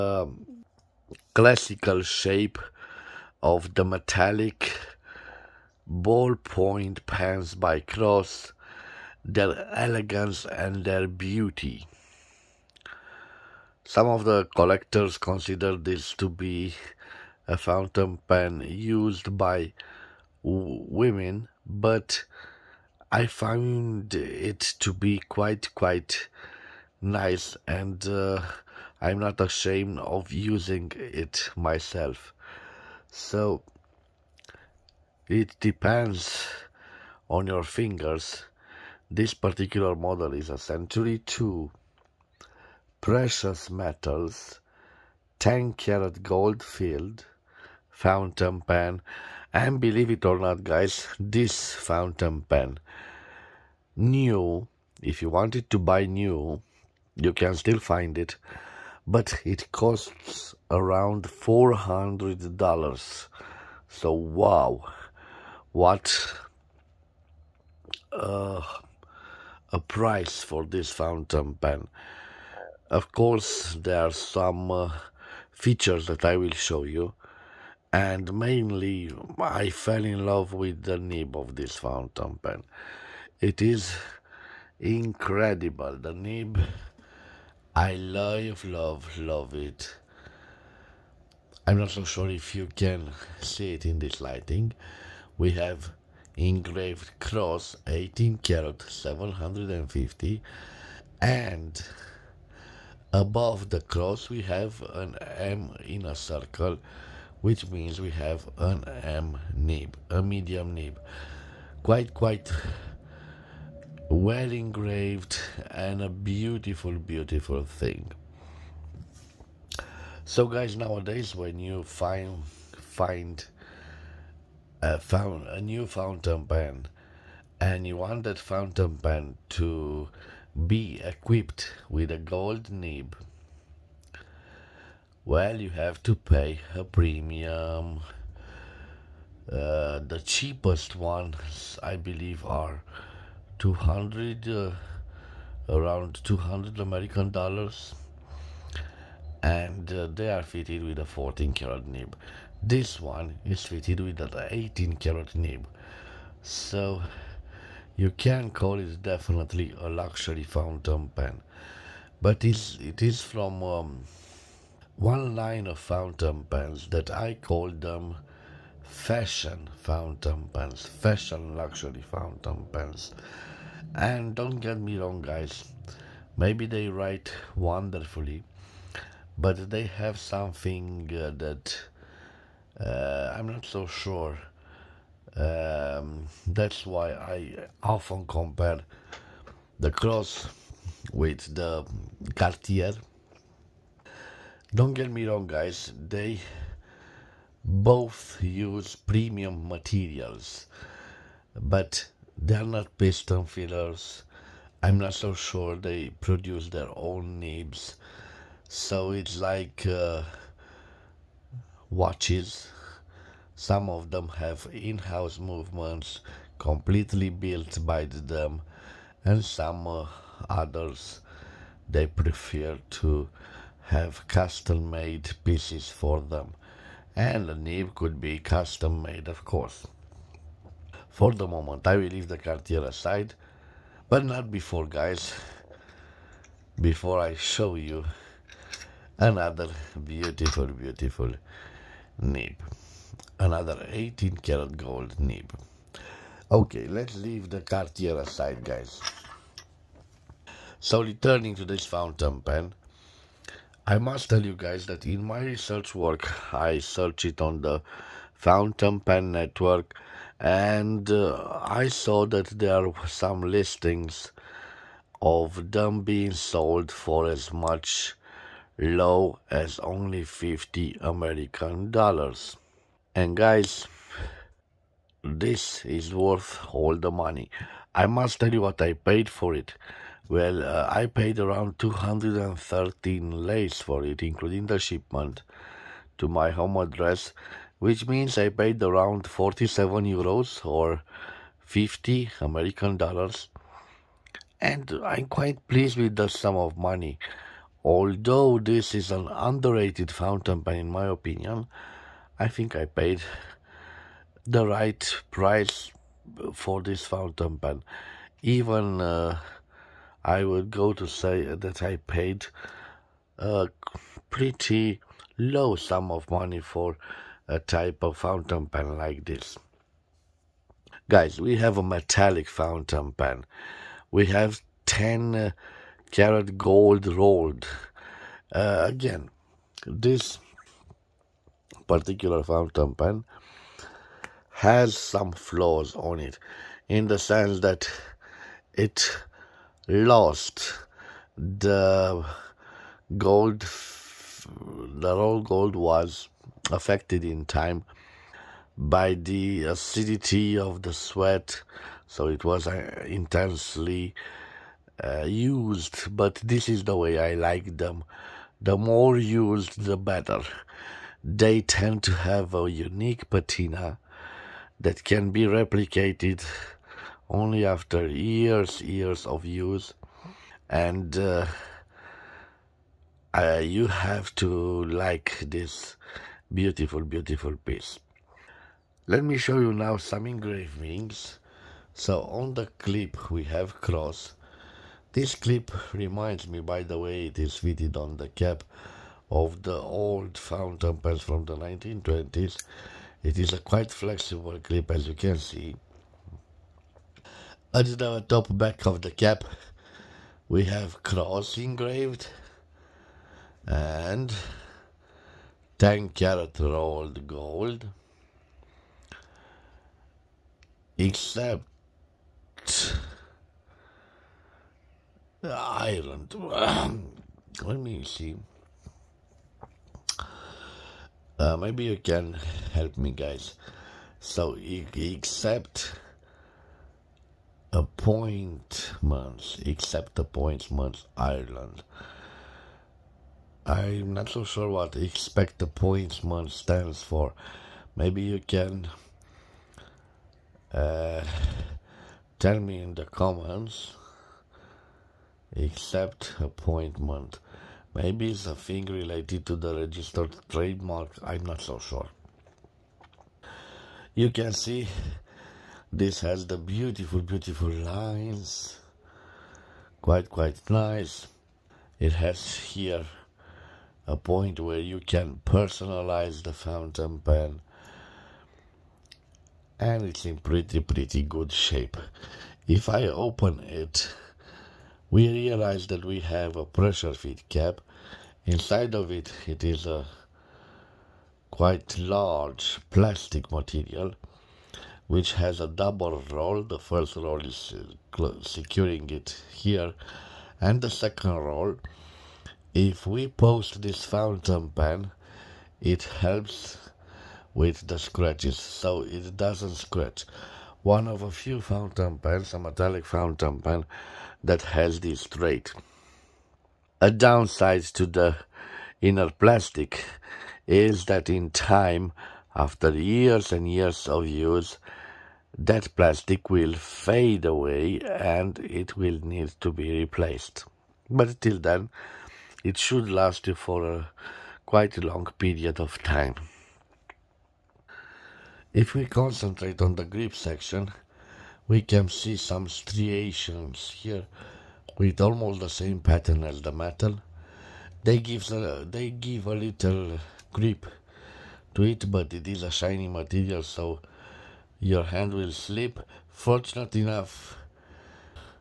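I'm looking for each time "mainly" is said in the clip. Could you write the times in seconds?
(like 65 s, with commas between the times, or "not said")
78 s.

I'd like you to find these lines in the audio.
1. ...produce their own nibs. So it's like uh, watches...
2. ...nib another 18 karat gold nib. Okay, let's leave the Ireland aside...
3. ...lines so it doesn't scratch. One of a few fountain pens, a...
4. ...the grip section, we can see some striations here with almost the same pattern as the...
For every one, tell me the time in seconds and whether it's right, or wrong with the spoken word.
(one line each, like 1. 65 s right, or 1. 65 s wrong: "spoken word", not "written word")
1. 206 s right
2. 242 s wrong: "Cartier", not "Ireland"
3. 497 s wrong: "scratches", not "lines"
4. 529 s right.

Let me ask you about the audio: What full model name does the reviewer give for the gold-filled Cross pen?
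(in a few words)
Century 2.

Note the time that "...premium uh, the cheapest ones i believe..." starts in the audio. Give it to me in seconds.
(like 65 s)
136 s.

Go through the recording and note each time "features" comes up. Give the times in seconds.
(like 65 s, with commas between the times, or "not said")
75 s.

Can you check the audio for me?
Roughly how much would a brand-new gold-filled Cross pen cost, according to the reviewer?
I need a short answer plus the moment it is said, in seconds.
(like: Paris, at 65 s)
$400, at 61 s.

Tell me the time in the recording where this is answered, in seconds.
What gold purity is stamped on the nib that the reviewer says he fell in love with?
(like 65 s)
97 s.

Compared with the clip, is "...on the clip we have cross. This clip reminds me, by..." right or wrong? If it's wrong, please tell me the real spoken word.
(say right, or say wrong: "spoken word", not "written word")
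right.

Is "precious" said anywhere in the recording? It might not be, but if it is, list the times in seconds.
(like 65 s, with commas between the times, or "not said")
43 s.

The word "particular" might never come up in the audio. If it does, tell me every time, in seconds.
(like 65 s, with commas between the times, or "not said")
39 s, 331 s.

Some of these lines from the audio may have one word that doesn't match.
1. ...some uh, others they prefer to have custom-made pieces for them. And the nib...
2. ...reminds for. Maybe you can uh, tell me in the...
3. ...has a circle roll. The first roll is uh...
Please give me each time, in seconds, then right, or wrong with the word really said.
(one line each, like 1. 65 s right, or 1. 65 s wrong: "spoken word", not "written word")
1. 219 s right
2. 436 s wrong: "stands", not "reminds"
3. 485 s wrong: "double", not "circle".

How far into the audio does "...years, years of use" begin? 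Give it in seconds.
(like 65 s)
368 s.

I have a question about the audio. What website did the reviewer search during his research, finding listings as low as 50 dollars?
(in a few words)
Fountain Pen Network.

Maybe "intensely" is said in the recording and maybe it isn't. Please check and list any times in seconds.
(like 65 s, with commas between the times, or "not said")
353 s.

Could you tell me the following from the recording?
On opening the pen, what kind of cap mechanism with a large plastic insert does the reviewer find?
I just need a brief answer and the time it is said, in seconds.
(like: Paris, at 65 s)
pressure feed cap, at 476 s.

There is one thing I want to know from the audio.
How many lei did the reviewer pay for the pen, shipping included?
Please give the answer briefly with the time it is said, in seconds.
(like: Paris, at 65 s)
213, at 281 s.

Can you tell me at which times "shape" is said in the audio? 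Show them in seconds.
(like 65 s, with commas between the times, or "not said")
2 s, 471 s.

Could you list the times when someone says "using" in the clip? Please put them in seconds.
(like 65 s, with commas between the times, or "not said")
30 s.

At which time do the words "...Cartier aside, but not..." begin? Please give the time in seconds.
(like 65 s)
232 s.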